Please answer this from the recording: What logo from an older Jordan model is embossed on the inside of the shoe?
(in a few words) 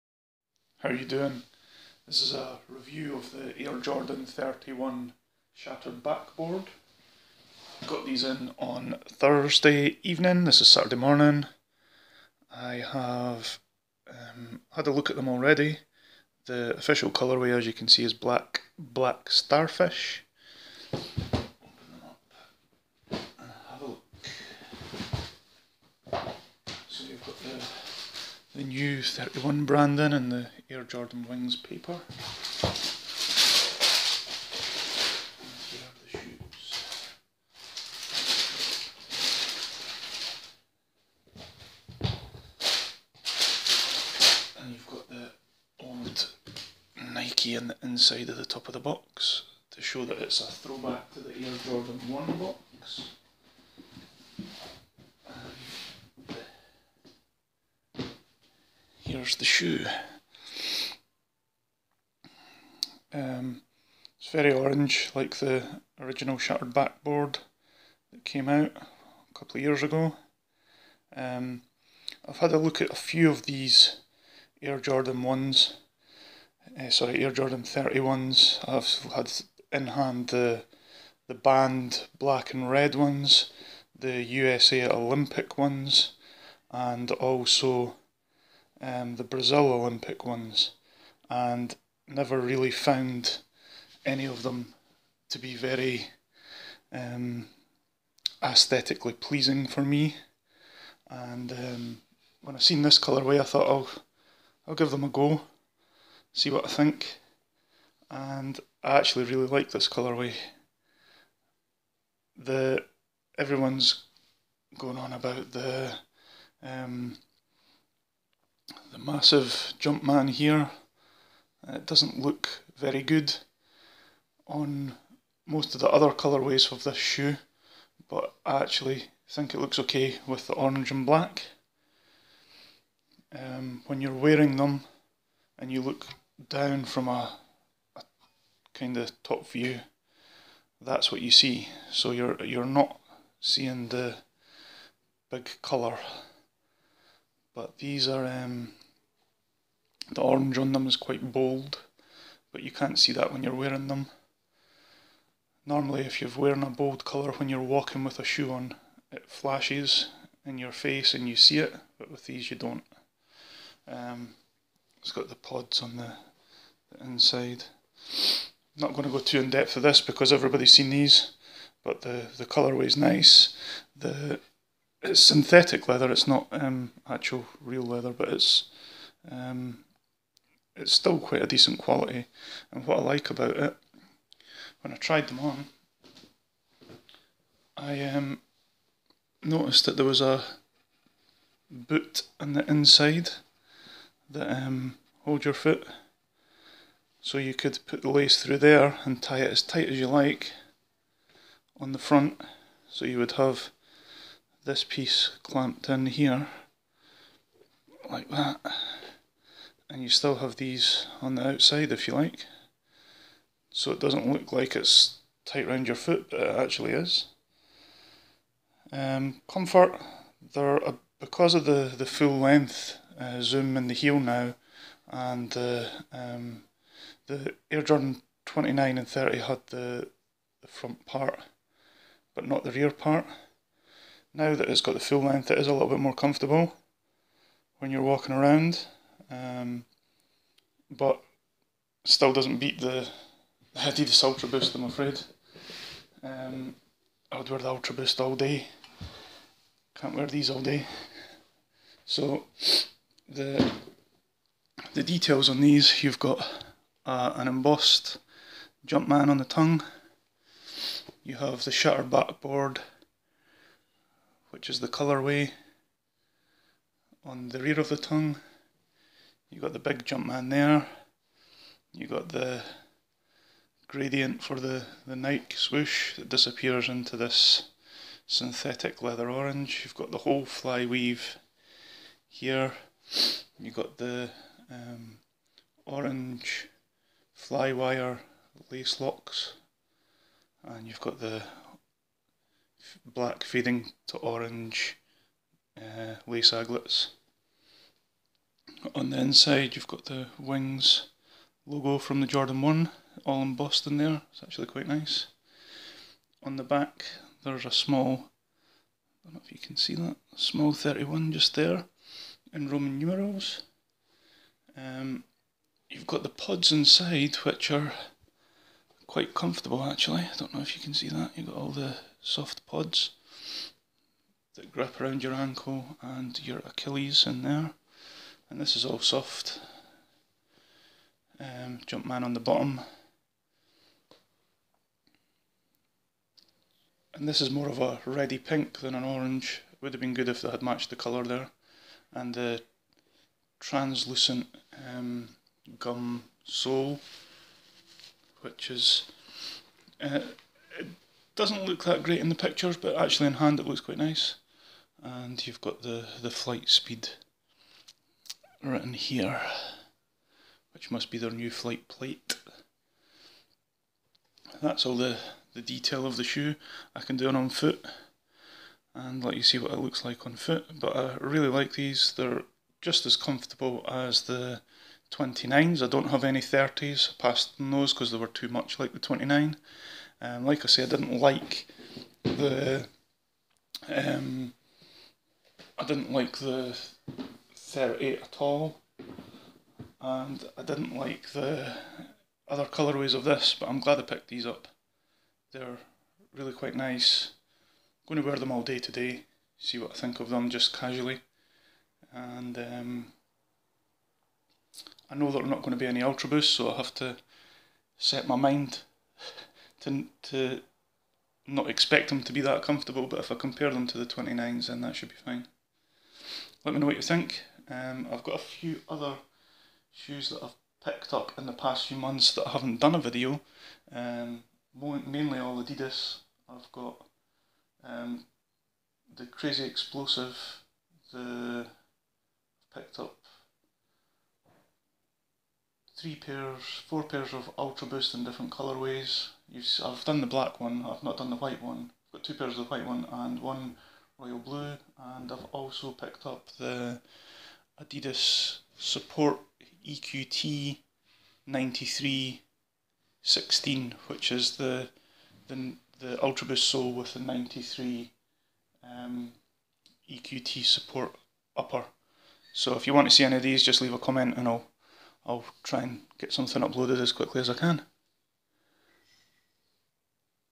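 wings logo.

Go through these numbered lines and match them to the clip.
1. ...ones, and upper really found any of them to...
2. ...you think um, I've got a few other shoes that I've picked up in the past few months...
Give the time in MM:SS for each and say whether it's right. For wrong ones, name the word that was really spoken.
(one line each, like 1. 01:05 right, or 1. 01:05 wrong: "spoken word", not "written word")
1. 01:30 wrong: "never", not "upper"
2. 06:56 right.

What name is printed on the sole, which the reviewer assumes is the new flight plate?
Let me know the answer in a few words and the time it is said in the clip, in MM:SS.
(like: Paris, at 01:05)
FlightSpeed, at 05:56.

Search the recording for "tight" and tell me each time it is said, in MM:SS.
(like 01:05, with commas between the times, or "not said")
03:19, 03:35.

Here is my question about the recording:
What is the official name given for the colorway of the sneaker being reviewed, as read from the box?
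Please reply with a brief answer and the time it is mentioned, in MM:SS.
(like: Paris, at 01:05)
black, black starfish, at 00:18.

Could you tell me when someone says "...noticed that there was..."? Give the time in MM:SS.
03:09.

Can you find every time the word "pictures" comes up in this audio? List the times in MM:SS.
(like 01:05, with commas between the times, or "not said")
05:52.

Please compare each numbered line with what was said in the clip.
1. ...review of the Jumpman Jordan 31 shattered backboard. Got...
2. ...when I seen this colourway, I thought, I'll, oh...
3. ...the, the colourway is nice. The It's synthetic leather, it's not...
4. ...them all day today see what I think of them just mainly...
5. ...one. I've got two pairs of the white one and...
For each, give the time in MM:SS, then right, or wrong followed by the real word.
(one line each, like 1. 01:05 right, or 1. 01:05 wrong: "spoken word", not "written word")
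1. 00:02 wrong: "Air", not "Jumpman"
2. 01:42 right
3. 02:52 right
4. 06:38 wrong: "casually", not "mainly"
5. 07:21 right.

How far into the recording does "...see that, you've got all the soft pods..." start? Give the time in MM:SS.
05:20.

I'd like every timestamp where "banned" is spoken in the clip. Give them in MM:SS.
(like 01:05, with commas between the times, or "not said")
01:21.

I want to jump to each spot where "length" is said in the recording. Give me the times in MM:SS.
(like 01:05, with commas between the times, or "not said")
03:42, 03:55.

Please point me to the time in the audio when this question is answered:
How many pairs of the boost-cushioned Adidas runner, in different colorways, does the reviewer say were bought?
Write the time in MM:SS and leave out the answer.
07:16.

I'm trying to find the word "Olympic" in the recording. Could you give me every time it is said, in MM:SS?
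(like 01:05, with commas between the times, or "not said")
01:24, 01:29.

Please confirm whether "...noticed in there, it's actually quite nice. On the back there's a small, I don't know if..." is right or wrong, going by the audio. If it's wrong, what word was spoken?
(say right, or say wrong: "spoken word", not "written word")
wrong: "embossed", not "noticed".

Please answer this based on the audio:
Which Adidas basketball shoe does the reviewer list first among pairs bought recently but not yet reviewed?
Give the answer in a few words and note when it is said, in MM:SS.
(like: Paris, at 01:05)
Crazy Explosive, at 07:09.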